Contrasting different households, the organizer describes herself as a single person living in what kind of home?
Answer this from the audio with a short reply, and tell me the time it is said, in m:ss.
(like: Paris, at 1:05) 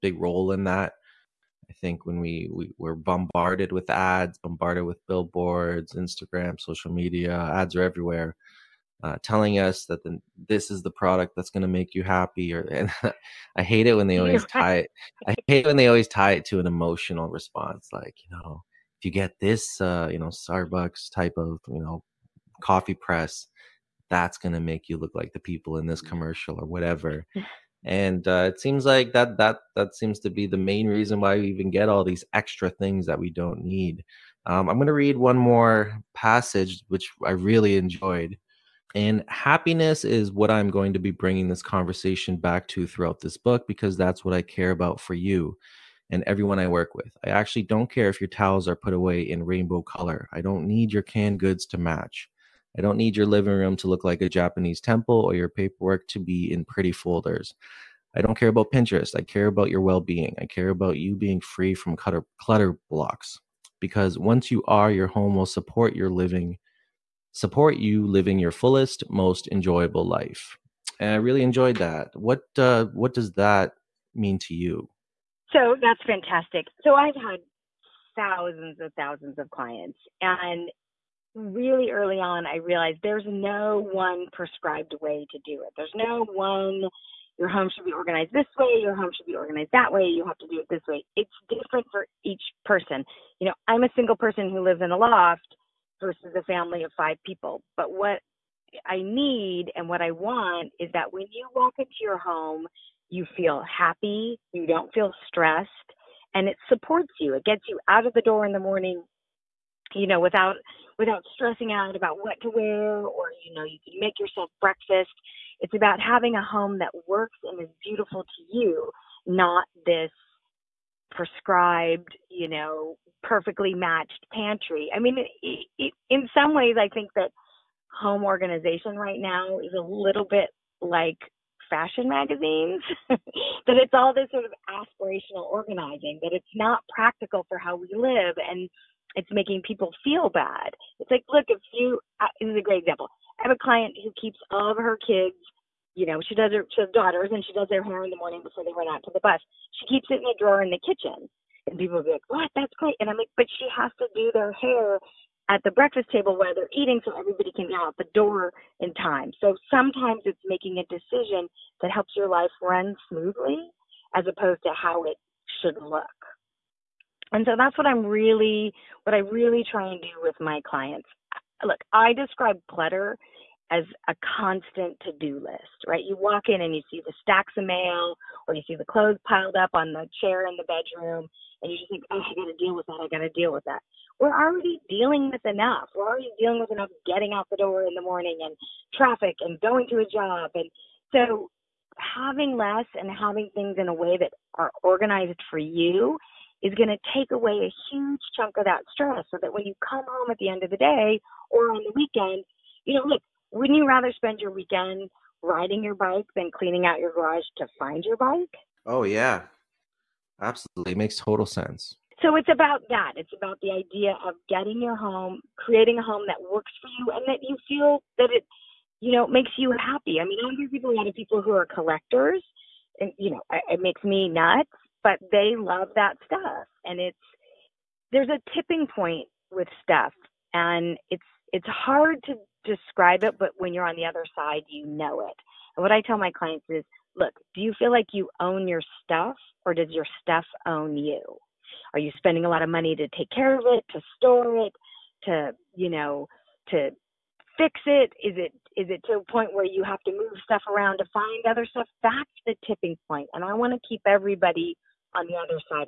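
a loft, at 1:34.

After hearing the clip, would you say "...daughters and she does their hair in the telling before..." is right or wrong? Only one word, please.
wrong.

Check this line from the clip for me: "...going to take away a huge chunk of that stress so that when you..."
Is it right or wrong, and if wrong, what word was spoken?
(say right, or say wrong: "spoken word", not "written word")
right.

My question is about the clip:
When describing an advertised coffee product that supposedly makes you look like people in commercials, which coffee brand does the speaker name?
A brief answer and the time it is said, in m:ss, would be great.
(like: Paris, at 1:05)
Starbucks, at 0:20.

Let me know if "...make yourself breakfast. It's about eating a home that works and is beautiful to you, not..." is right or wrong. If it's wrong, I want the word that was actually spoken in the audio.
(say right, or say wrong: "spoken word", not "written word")
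wrong: "having", not "eating".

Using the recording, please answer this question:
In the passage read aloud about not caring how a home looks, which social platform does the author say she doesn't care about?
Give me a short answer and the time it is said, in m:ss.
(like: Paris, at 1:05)
Pinterest, at 0:58.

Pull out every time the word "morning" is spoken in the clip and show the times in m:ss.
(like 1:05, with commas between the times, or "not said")
1:48, 2:28, 3:08.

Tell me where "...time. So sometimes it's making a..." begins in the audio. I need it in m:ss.
2:38.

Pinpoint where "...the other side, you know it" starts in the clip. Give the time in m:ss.
3:53.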